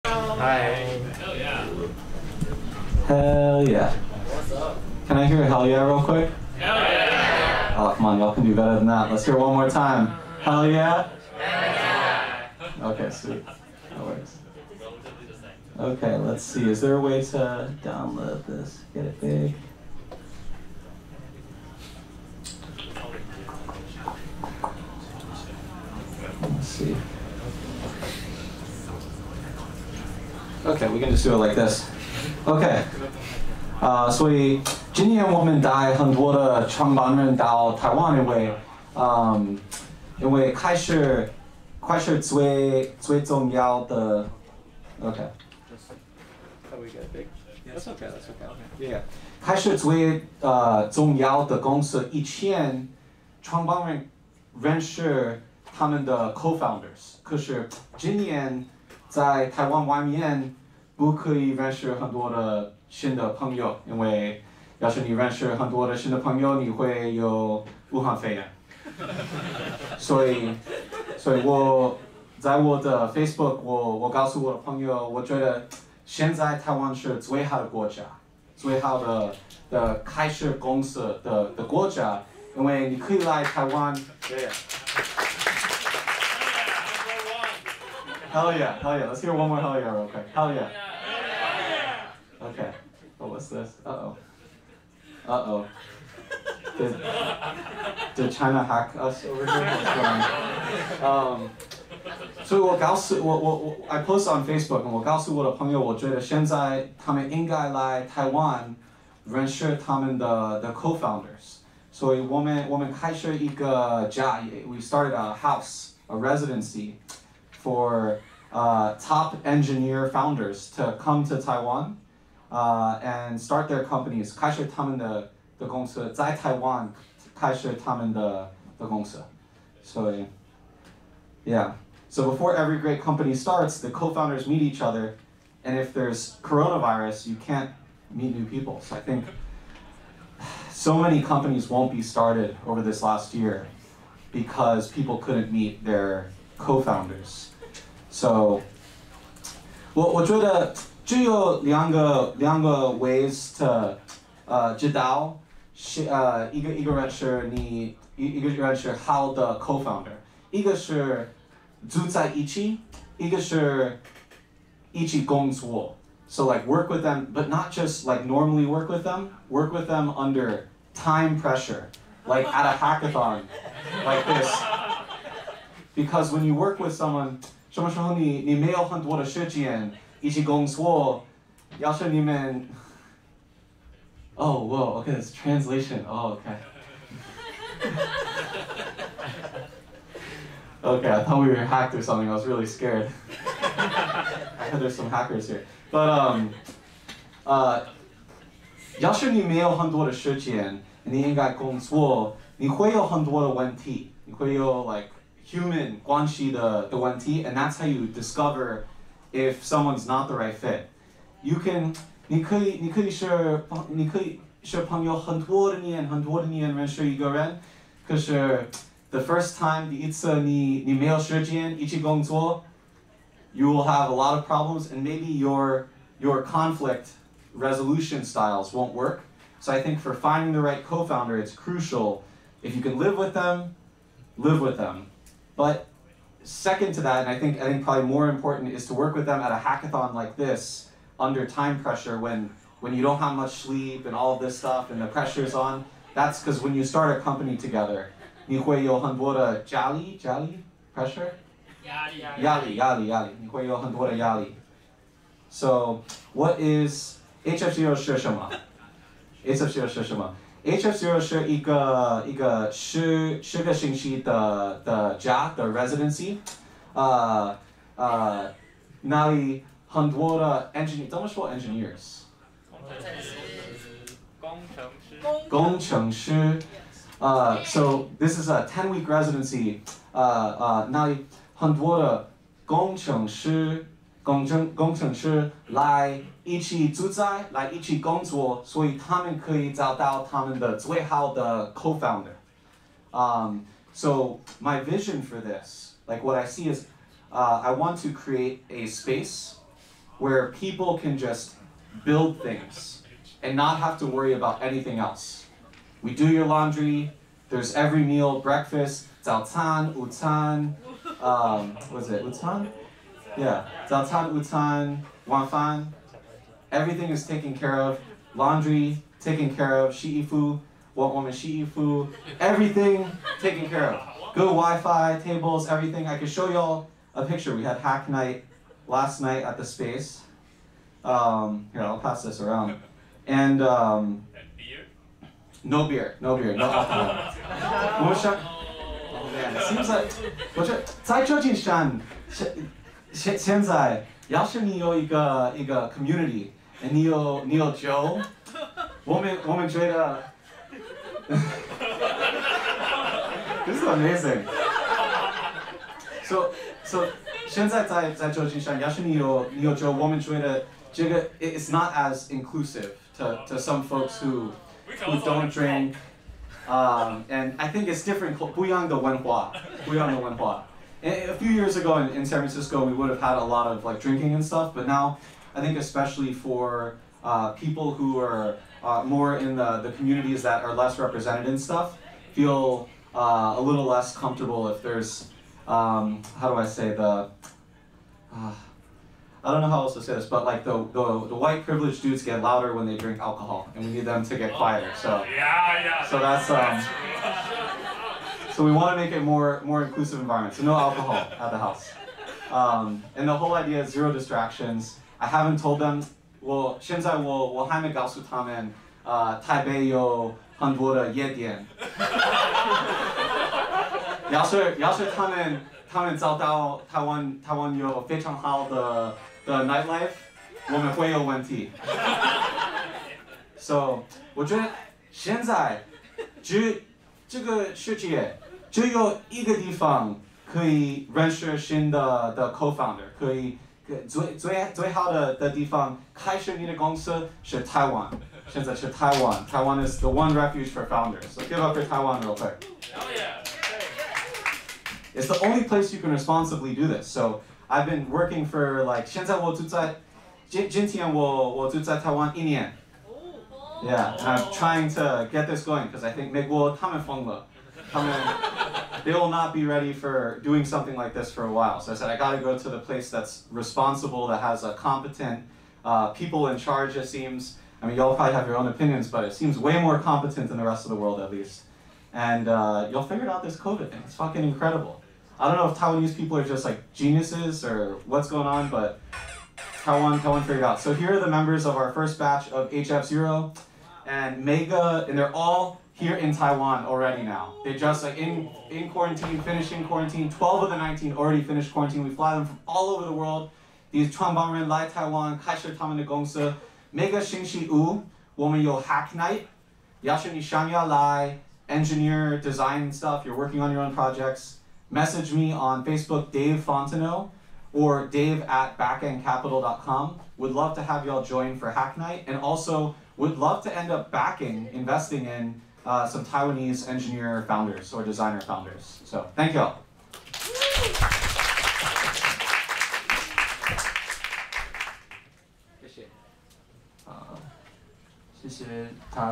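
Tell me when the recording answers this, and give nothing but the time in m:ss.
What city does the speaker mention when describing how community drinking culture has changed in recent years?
6:12.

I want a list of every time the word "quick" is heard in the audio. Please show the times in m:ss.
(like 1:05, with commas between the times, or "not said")
0:06, 7:22.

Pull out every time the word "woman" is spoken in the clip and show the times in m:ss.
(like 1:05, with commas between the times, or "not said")
5:21.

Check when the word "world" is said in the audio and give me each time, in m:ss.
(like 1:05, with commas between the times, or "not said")
7:50, 8:13.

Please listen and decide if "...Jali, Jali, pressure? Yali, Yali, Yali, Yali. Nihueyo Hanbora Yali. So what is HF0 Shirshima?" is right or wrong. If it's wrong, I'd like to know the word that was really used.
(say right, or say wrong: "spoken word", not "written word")
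right.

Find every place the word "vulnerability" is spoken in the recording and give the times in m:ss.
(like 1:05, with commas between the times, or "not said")
not said.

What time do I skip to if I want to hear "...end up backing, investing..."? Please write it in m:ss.
8:33.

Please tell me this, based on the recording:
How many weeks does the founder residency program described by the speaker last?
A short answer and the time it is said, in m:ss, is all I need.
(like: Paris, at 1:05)
10, at 4:38.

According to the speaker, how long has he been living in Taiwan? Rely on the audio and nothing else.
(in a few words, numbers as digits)
1 year.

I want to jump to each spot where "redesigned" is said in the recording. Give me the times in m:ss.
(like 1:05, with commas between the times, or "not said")
not said.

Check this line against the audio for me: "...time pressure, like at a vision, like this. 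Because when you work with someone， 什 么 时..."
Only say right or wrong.
wrong.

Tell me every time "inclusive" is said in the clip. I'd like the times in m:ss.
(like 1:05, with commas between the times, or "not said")
6:02, 6:39.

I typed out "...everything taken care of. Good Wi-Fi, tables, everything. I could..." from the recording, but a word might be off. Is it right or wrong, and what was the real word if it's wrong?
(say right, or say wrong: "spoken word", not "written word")
right.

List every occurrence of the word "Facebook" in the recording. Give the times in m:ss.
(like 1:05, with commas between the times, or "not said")
1:13, 1:44, 8:25.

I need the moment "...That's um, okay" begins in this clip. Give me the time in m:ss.
0:45.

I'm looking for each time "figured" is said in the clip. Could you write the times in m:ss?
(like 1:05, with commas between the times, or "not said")
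7:53, 8:00.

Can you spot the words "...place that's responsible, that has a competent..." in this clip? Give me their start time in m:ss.
7:42.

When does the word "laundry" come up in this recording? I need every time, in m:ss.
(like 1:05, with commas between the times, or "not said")
5:06, 5:18.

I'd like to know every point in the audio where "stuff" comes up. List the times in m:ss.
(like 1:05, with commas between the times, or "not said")
4:04, 6:14, 6:21, 8:22.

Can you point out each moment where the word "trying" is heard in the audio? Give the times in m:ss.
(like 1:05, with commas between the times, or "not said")
7:34.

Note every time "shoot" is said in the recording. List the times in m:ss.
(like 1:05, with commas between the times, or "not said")
not said.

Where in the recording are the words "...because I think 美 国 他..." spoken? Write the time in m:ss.
7:35.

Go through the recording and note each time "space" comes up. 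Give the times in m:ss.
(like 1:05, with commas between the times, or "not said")
4:58, 5:29.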